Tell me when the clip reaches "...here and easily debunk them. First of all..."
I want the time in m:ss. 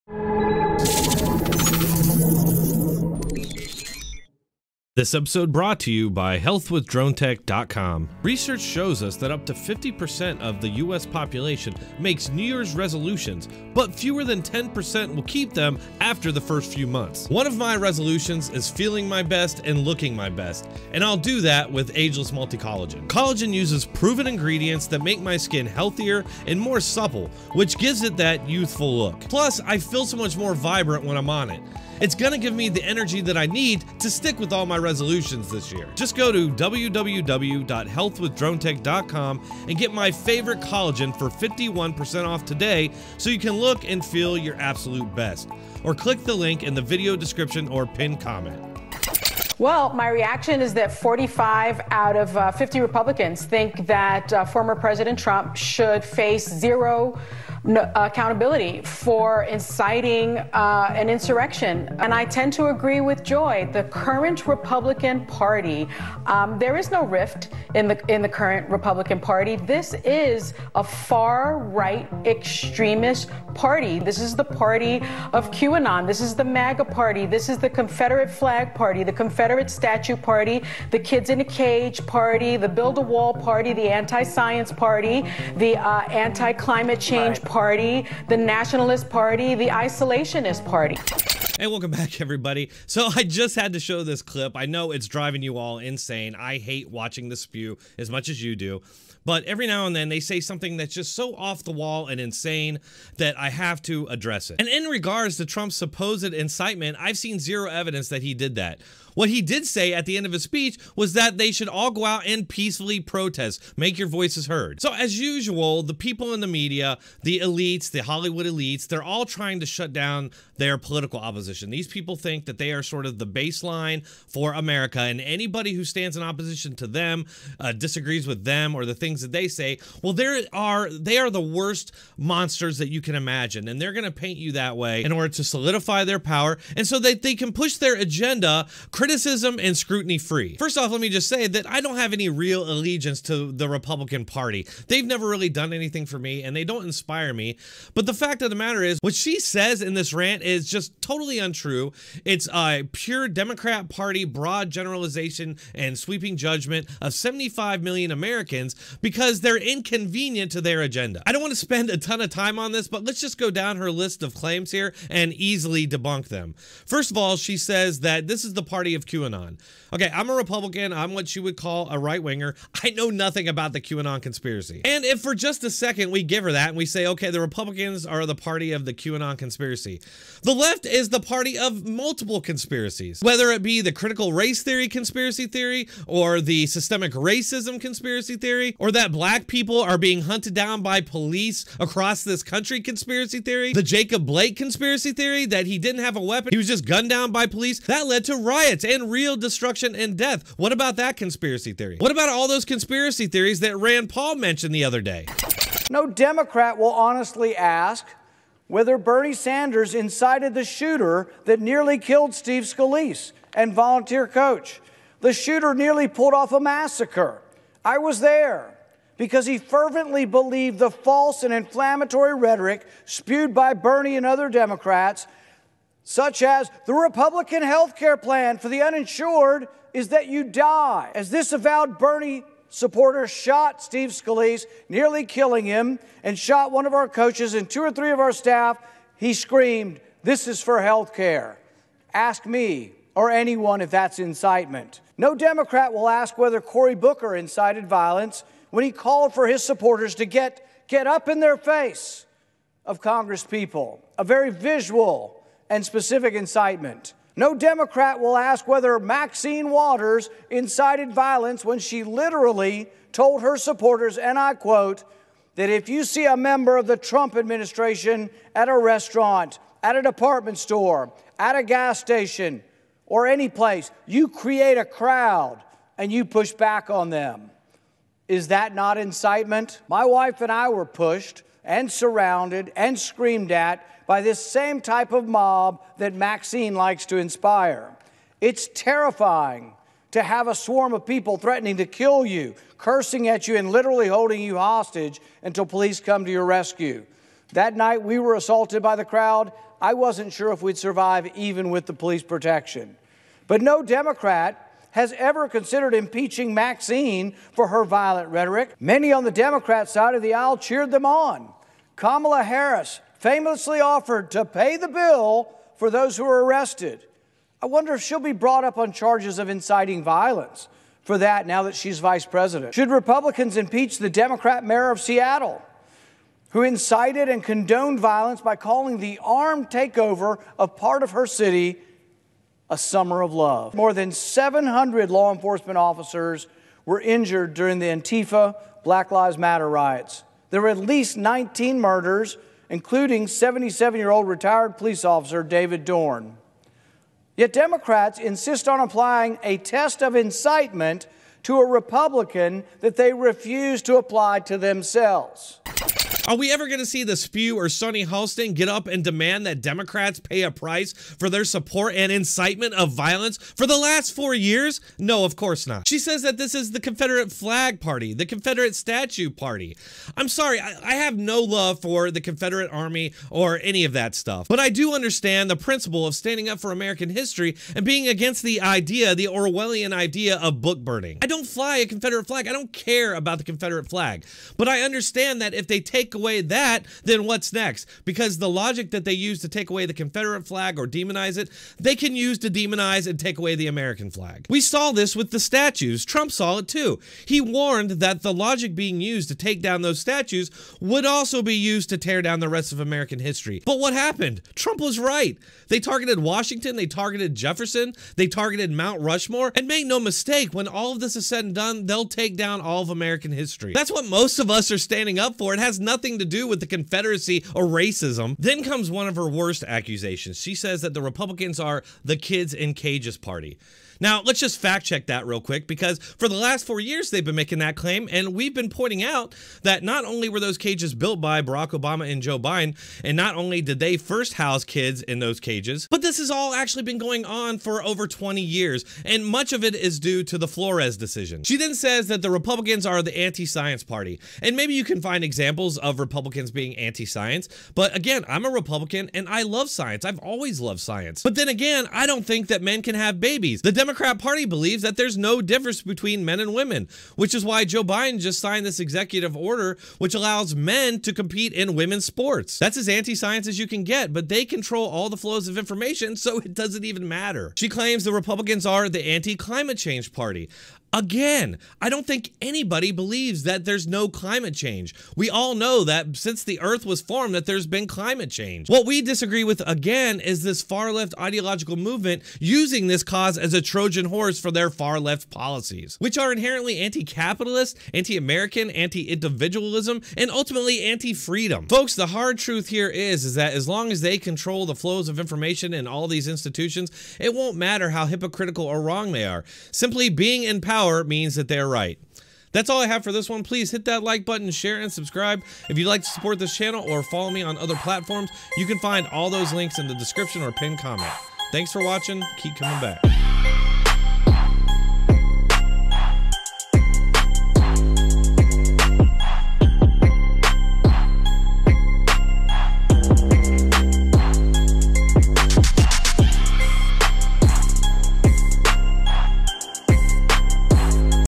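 2:44.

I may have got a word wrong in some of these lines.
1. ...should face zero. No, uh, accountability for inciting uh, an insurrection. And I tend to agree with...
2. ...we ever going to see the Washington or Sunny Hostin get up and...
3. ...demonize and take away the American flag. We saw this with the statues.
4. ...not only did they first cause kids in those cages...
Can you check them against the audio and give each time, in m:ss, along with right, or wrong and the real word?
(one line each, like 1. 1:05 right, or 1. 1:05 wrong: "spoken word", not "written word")
1. 0:55 right
2. 5:56 wrong: "Spew", not "Washington"
3. 6:32 right
4. 7:13 wrong: "house", not "cause".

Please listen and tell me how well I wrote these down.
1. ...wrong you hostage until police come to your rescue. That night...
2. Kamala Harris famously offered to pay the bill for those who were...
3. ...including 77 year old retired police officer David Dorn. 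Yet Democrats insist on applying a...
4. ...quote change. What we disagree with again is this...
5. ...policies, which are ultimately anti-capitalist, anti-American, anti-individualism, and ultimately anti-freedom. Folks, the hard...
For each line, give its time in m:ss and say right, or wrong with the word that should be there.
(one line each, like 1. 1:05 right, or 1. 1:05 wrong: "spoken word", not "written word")
1. 4:54 wrong: "holding", not "wrong"
2. 5:11 right
3. 5:42 right
4. 7:57 wrong: "climate", not "quote"
5. 8:05 wrong: "inherently", not "ultimately".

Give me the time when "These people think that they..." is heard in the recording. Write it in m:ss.
2:01.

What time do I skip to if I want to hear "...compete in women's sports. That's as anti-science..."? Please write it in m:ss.
7:41.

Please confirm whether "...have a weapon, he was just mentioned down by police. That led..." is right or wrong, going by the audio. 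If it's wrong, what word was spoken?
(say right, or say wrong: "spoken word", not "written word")
wrong: "gunned", not "mentioned".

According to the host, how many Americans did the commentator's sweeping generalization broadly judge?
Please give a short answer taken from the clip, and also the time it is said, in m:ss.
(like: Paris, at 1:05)
75 million, at 2:37.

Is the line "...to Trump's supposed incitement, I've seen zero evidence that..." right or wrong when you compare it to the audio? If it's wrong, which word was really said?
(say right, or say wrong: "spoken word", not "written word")
right.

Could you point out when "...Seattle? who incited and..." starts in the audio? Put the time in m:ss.
5:25.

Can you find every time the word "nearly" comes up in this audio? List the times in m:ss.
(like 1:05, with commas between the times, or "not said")
3:31, 3:35, 3:54.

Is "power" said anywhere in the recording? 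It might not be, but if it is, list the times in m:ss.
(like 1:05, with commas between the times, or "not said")
2:16, 8:20.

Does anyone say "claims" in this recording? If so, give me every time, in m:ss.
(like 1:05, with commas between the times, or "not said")
2:44, 7:07, 7:47.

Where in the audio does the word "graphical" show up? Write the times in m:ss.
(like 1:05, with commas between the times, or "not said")
not said.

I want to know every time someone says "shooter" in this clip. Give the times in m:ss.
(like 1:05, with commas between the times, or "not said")
3:30, 3:35.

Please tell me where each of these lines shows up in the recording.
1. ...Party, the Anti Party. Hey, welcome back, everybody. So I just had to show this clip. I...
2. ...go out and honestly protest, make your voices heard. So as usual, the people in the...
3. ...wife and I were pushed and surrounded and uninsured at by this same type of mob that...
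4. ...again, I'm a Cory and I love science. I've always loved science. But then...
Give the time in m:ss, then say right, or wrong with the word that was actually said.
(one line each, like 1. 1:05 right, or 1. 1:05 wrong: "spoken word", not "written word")
1. 1:29 wrong: "Isolationist", not "Anti"
2. 1:51 wrong: "peacefully", not "honestly"
3. 4:40 wrong: "screamed", not "uninsured"
4. 7:27 wrong: "Republican", not "Cory".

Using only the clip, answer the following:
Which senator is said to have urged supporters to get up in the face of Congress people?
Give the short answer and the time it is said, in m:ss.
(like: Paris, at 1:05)
Cory Booker, at 4:06.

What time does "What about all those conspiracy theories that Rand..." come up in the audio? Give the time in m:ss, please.
3:21.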